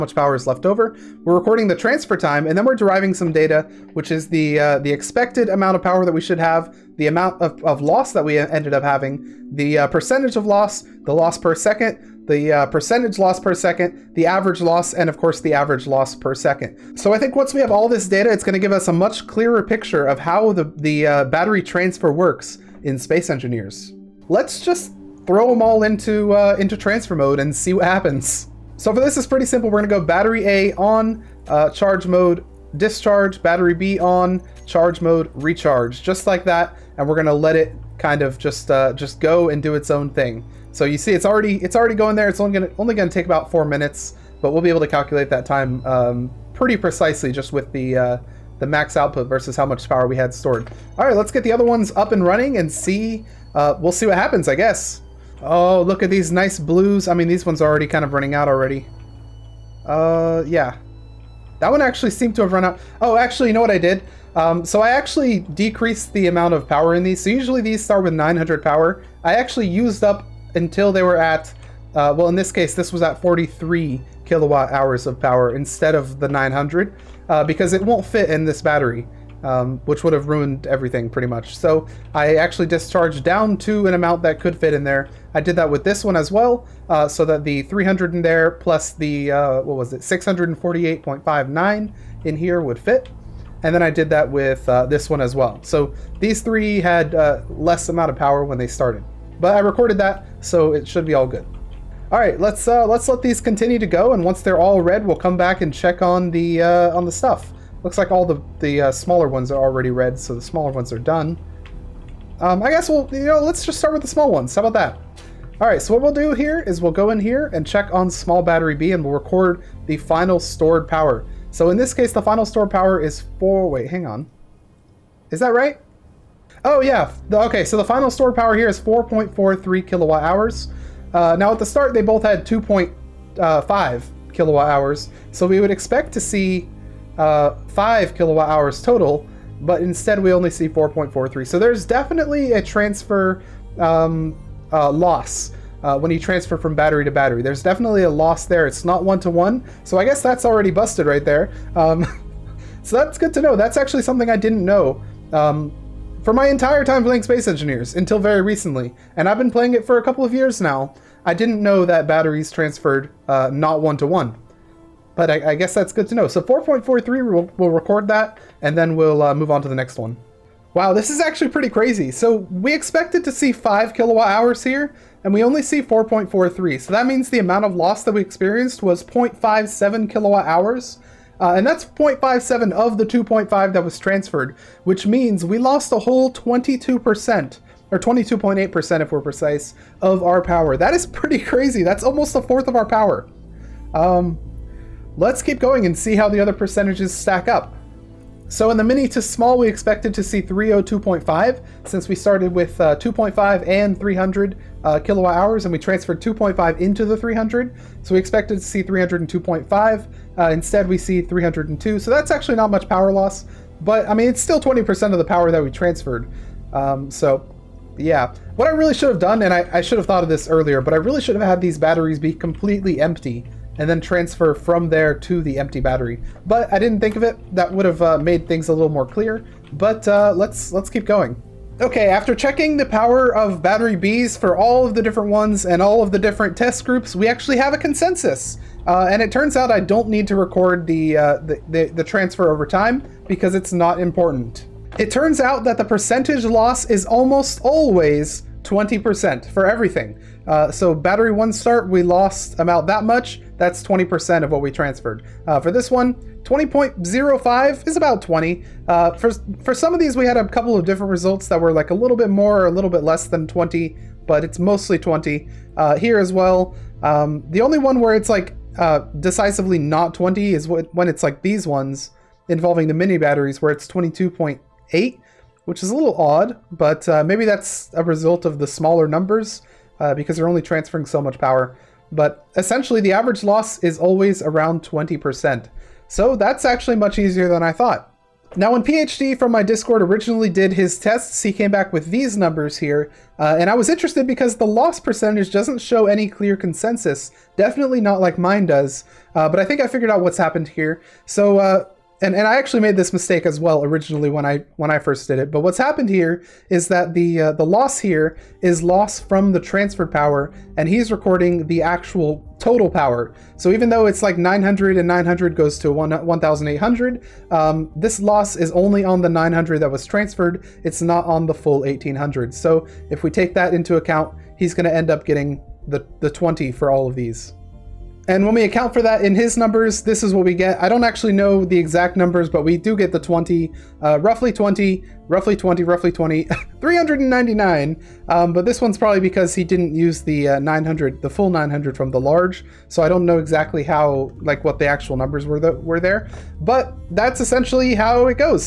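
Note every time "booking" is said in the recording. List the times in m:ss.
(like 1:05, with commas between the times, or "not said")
not said.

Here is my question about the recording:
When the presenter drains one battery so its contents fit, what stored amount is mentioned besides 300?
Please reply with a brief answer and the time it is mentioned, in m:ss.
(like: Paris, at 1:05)
648.59, at 1:30.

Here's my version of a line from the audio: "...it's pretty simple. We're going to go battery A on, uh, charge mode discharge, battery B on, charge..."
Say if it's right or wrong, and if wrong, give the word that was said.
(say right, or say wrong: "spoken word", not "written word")
right.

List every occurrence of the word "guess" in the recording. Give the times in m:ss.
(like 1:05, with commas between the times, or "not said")
0:54, 1:52, 2:30, 2:45.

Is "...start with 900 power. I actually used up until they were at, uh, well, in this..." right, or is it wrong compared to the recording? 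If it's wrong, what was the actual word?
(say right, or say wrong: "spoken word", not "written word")
right.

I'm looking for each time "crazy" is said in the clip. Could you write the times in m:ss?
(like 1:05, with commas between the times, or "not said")
2:51, 3:11.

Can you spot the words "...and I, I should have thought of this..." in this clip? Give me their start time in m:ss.
3:39.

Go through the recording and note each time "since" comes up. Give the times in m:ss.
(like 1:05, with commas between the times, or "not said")
3:21.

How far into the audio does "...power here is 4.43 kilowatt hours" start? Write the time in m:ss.
2:08.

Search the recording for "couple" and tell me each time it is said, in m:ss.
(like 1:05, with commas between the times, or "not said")
2:40, 4:20.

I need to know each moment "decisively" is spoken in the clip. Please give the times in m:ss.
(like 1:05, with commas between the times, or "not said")
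4:29.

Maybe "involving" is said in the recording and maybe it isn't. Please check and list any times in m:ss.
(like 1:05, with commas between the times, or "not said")
4:32.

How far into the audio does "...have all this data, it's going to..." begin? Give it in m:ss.
0:17.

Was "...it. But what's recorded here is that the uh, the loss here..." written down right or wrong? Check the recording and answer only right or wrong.
wrong.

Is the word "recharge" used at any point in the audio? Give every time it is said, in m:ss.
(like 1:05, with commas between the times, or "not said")
0:35.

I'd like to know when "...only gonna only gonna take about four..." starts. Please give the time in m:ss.
0:42.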